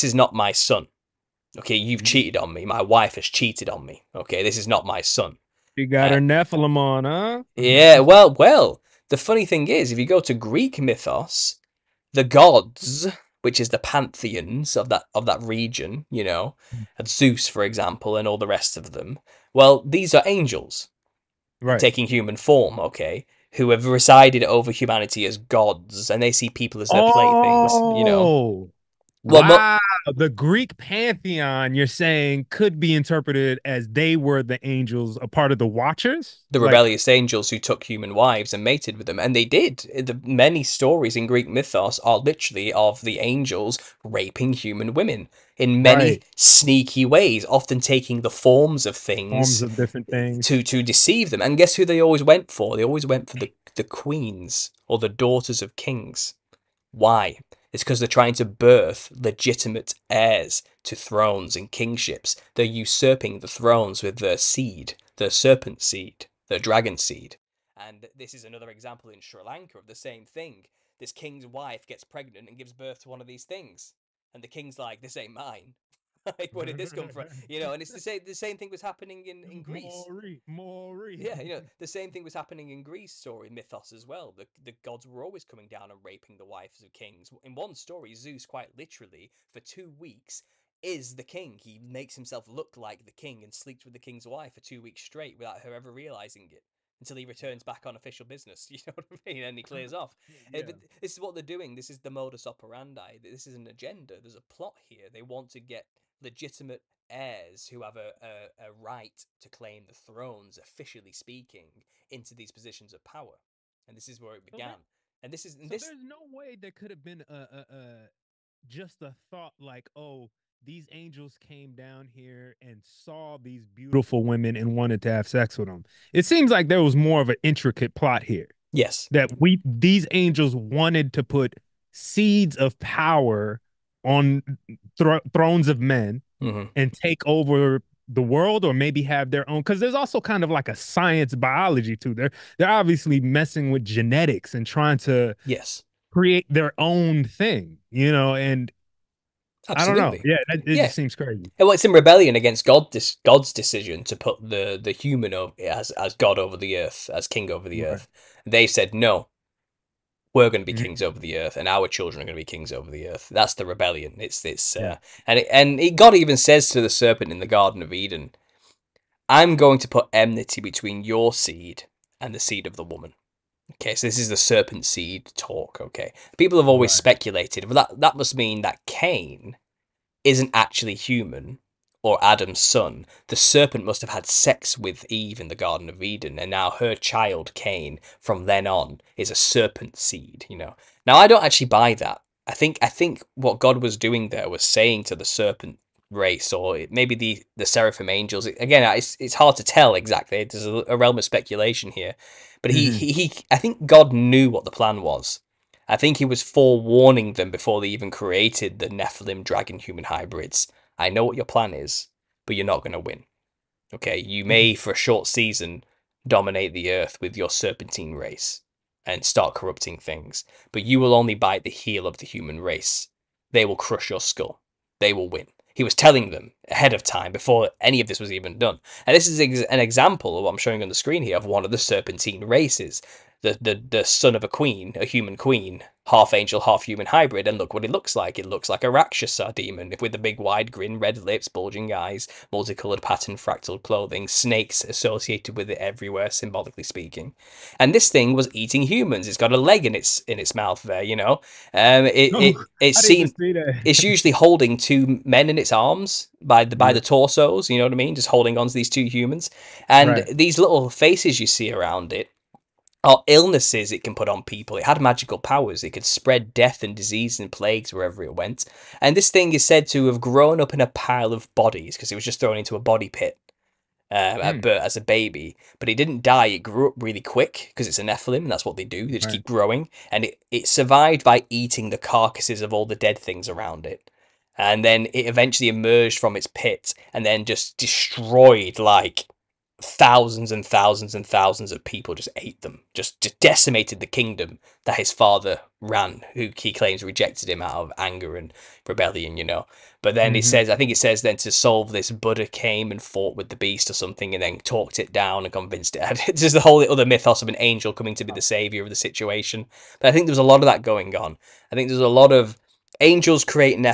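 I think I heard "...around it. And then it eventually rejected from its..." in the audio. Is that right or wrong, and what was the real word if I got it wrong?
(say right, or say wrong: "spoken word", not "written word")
wrong: "emerged", not "rejected".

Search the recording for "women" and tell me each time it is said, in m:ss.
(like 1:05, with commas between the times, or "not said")
0:44, 2:04.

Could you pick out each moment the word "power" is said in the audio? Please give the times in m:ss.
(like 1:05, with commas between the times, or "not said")
1:53, 2:12, 4:25.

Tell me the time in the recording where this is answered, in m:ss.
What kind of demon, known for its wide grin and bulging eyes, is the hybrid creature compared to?
3:58.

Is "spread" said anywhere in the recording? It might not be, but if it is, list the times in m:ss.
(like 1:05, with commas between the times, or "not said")
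4:26.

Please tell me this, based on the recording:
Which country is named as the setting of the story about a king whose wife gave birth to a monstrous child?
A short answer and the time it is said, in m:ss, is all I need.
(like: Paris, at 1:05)
Sri Lanka, at 1:09.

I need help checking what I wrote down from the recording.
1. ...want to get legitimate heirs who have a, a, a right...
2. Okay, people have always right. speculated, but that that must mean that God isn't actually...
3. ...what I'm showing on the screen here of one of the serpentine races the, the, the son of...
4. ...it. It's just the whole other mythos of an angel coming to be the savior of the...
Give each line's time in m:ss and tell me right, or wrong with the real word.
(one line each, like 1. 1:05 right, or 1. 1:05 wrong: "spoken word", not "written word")
1. 1:45 right
2. 2:55 wrong: "Cain", not "God"
3. 3:50 right
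4. 5:05 right.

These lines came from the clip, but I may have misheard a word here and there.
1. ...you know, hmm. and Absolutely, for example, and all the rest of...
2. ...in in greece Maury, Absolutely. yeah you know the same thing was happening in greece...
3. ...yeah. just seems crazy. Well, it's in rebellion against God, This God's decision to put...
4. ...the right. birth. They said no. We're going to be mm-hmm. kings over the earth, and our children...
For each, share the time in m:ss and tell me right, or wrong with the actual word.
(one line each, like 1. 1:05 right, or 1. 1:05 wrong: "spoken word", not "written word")
1. 0:16 wrong: "Zeus", not "Absolutely"
2. 1:19 wrong: "Maury", not "Absolutely"
3. 2:30 right
4. 2:37 wrong: "earth", not "birth".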